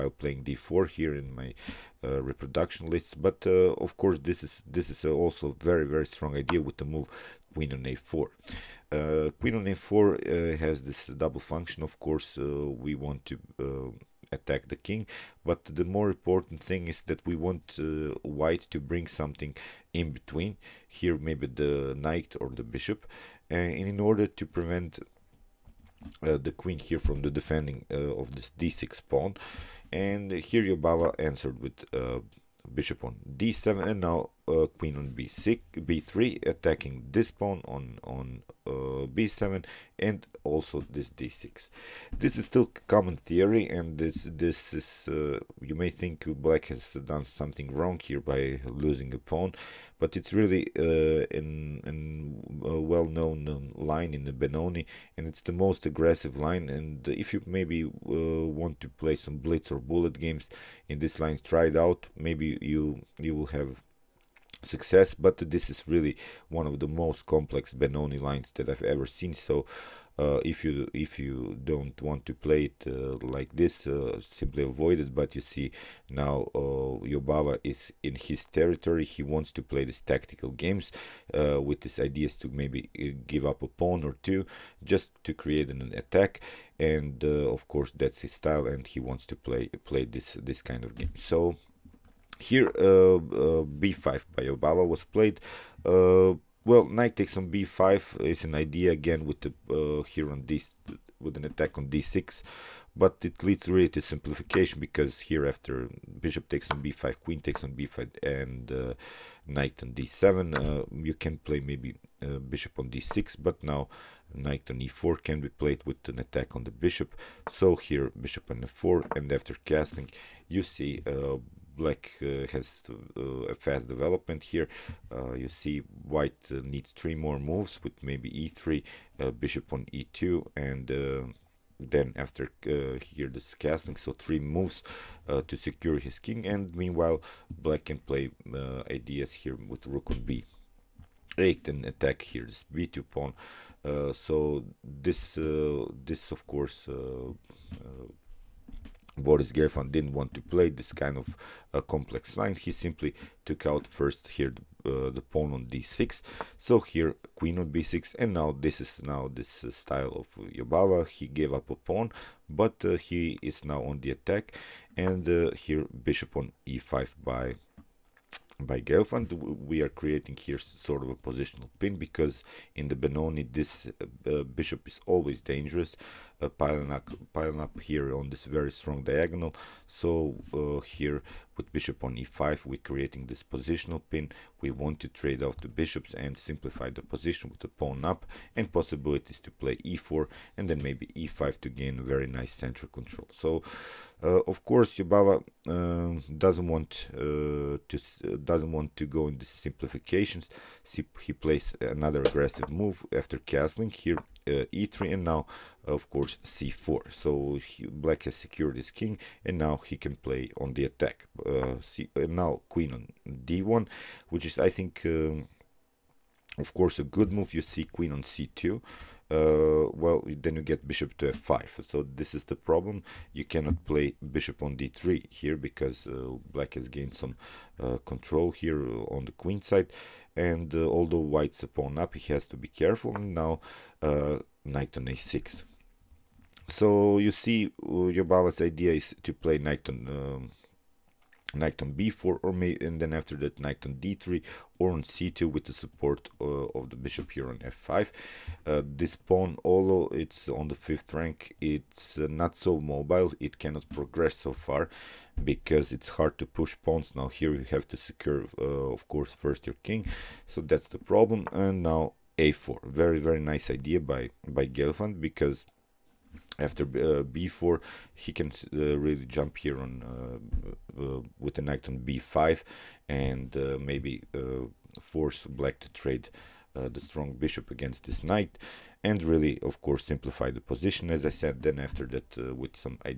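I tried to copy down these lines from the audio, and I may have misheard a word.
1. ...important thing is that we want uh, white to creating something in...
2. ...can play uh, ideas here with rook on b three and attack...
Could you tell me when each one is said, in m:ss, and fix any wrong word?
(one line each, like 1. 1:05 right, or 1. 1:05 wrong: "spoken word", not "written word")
1. 0:16 wrong: "bring", not "creating"
2. 2:17 wrong: "eight", not "three".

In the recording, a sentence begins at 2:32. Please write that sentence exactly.
He simply took out first here the, uh, the, pawn on d6.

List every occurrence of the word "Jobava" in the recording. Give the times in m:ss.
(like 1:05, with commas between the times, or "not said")
0:30, 1:17, 1:34, 2:40, 3:14, 3:58.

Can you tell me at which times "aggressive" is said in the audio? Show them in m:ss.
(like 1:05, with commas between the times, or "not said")
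0:55, 3:22.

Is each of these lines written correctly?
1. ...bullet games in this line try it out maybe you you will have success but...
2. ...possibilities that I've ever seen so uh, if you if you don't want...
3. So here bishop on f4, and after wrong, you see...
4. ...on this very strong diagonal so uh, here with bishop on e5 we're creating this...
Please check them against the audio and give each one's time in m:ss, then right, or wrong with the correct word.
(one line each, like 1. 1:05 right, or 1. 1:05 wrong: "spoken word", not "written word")
1. 0:59 right
2. 1:08 wrong: "lines", not "possibilities"
3. 1:57 wrong: "castling", not "wrong"
4. 2:58 right.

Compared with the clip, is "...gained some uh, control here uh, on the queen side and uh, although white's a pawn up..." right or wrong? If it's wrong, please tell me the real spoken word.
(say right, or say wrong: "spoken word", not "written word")
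right.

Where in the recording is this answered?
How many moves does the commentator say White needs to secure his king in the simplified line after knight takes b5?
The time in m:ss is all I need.
2:06.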